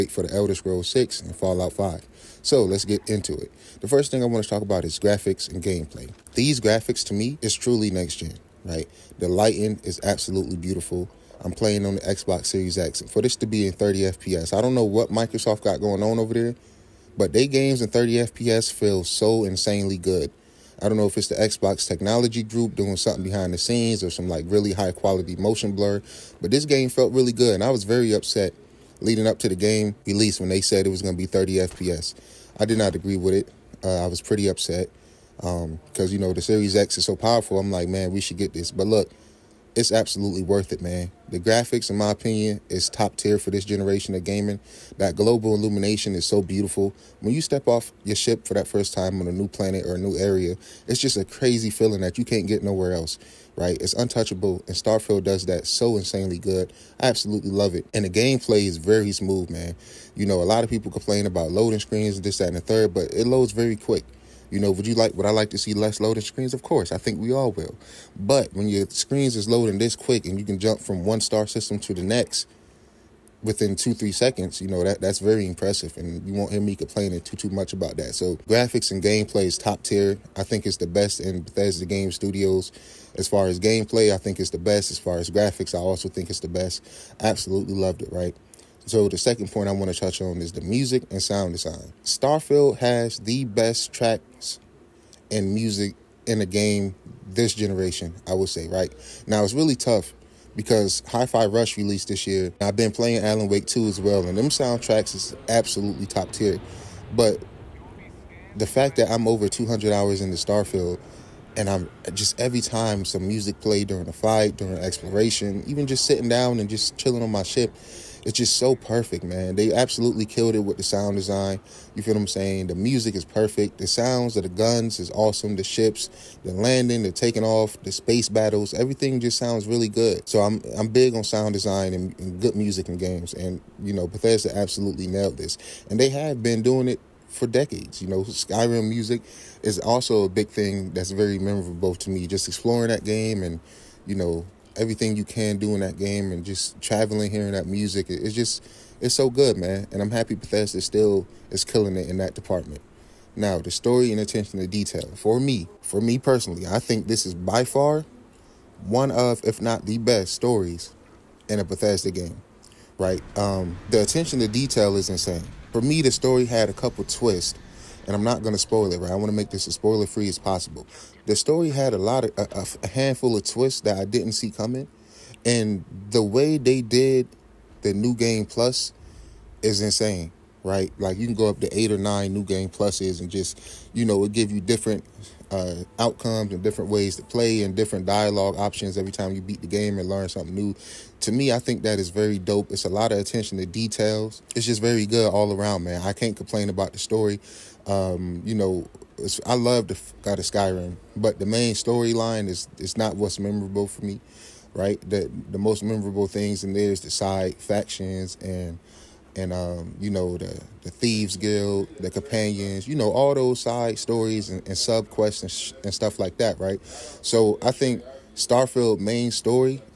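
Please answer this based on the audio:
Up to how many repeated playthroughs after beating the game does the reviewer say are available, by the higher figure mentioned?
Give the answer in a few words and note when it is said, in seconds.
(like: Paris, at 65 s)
9, at 181 s.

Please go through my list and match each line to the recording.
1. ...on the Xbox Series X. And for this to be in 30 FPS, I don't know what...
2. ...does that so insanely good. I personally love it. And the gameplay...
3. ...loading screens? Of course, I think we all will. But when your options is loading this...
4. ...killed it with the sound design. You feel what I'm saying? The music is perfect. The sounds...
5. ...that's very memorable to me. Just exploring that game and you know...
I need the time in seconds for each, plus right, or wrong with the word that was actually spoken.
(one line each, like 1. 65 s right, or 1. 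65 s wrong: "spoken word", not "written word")
1. 11 s right
2. 55 s wrong: "absolutely", not "personally"
3. 65 s wrong: "screens", not "options"
4. 120 s right
5. 140 s right.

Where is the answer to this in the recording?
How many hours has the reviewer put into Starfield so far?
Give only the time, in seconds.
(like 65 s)
109 s.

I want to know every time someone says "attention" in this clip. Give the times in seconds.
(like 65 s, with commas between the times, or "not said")
154 s, 164 s, 193 s.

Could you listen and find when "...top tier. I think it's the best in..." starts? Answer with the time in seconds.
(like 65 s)
79 s.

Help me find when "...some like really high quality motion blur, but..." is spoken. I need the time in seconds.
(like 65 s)
24 s.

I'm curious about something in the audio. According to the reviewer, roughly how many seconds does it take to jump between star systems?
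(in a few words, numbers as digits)
2-3 seconds.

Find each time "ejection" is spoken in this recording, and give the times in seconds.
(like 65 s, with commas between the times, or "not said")
not said.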